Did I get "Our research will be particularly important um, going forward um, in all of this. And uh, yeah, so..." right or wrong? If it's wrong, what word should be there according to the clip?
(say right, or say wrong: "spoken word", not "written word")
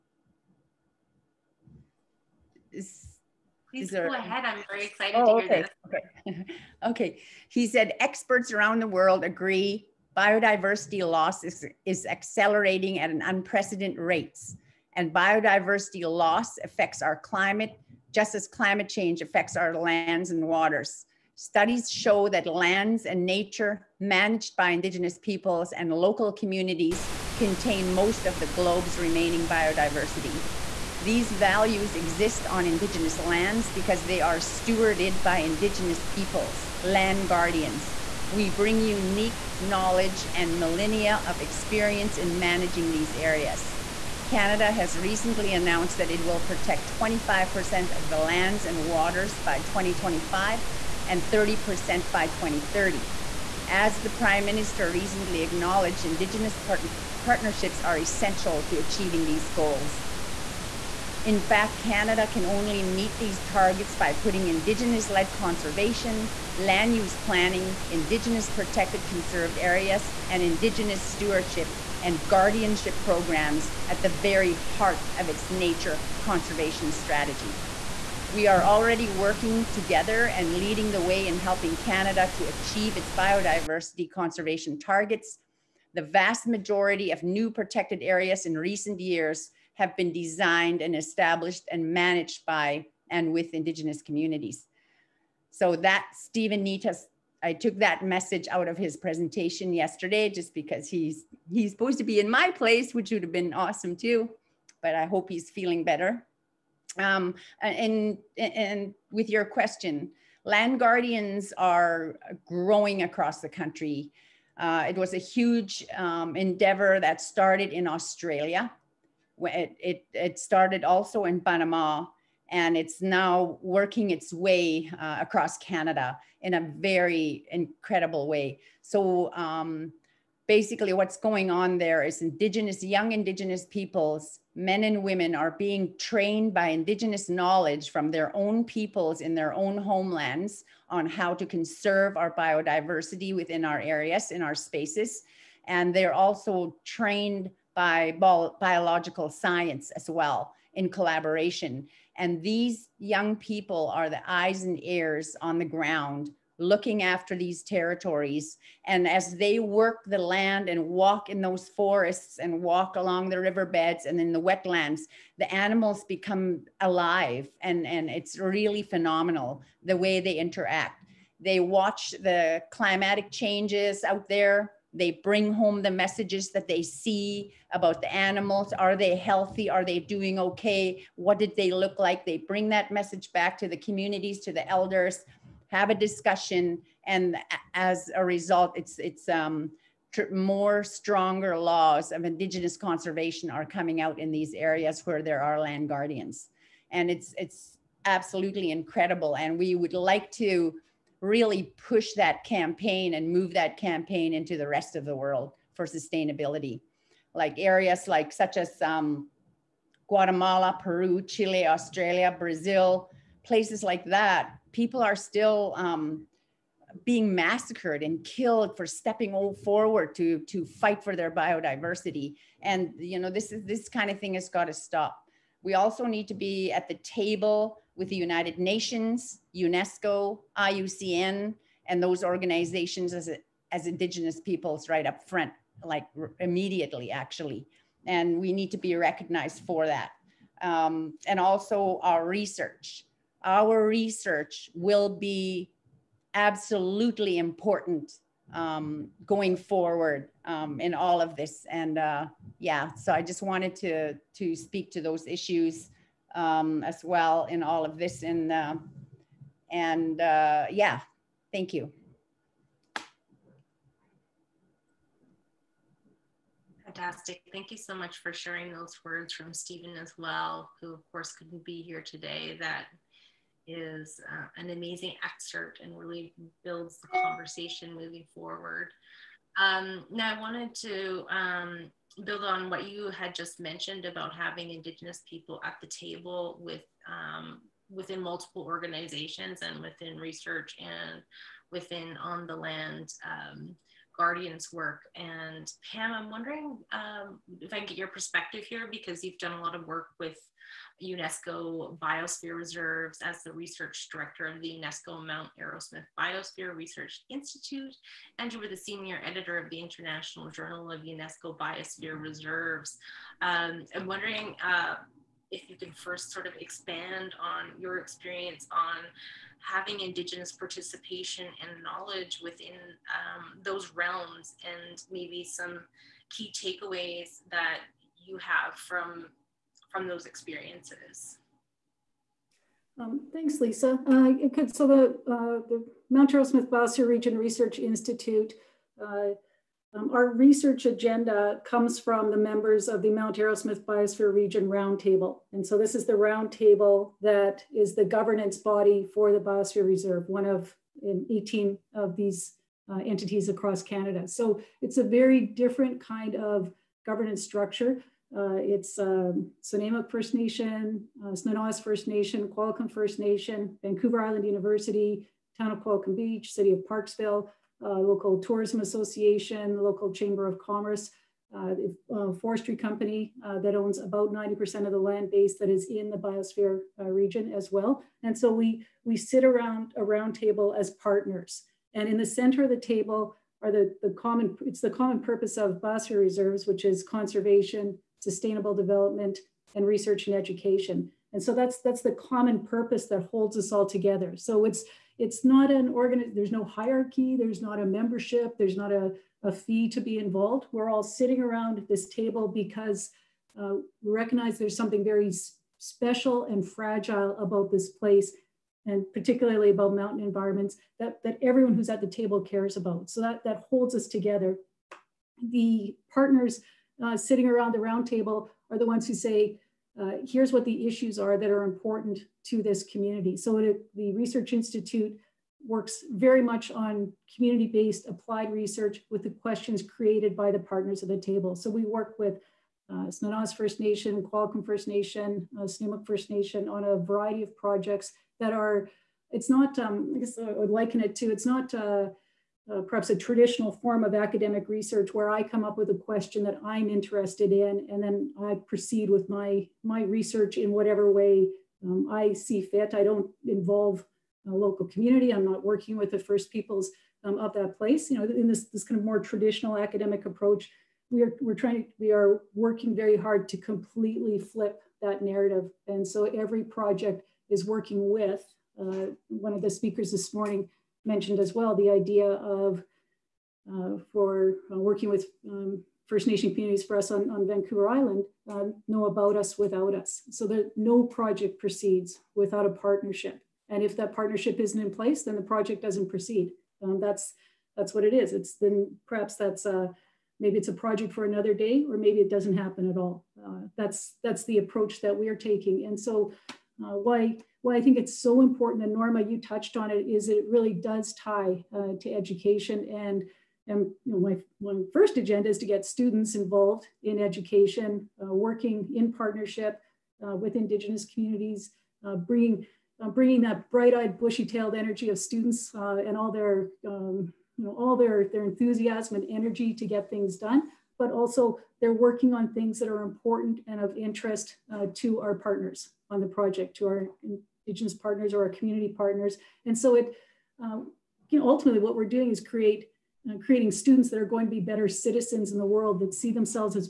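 wrong: "absolutely", not "particularly".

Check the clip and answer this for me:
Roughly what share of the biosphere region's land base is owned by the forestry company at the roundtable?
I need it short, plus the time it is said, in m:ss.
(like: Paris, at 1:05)
90%, at 6:14.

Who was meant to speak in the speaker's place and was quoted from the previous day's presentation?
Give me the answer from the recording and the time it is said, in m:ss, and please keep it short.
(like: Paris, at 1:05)
Steven Nitah, at 1:36.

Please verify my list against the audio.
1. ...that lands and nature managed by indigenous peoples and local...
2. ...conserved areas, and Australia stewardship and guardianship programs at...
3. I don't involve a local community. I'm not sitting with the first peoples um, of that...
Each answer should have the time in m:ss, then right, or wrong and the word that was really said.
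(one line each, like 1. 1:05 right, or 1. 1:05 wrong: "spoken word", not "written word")
1. 0:22 right
2. 1:09 wrong: "Indigenous", not "Australia"
3. 7:32 wrong: "working", not "sitting".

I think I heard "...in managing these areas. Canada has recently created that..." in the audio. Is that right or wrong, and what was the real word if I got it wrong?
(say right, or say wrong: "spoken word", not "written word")
wrong: "announced", not "created".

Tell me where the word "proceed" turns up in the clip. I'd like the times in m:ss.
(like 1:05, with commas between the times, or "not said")
7:28, 8:01, 8:06.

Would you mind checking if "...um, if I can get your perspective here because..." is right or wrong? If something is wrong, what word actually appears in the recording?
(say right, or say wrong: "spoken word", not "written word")
right.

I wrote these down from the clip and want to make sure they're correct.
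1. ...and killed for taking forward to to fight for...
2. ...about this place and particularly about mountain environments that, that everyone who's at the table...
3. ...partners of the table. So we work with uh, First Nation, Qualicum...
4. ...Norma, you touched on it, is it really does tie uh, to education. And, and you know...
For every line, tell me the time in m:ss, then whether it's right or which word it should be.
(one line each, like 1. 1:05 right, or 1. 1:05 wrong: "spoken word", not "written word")
1. 3:38 wrong: "stepping", not "taking"
2. 6:47 right
3. 7:10 right
4. 8:18 right.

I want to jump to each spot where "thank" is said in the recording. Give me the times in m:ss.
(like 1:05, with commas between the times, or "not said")
4:21, 4:27, 5:33.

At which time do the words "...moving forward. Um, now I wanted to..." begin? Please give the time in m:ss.
4:37.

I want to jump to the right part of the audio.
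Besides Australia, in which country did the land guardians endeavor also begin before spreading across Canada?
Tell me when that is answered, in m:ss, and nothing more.
2:01.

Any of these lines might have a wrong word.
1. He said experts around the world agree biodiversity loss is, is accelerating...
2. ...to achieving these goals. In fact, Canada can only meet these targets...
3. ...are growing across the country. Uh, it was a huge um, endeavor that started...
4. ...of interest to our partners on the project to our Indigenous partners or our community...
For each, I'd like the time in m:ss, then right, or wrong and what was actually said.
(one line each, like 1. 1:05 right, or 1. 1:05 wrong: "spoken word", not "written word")
1. 0:07 right
2. 0:58 right
3. 1:51 right
4. 8:43 right.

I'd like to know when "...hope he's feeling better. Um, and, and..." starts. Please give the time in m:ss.
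1:45.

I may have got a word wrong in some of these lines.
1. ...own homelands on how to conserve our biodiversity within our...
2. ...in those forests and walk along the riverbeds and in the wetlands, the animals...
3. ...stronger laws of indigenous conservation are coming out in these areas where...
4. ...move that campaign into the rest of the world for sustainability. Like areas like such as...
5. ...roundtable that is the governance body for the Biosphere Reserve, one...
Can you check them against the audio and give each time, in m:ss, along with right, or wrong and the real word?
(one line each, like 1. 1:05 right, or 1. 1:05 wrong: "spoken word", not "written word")
1. 2:19 right
2. 2:41 right
3. 3:10 right
4. 3:23 right
5. 5:46 right.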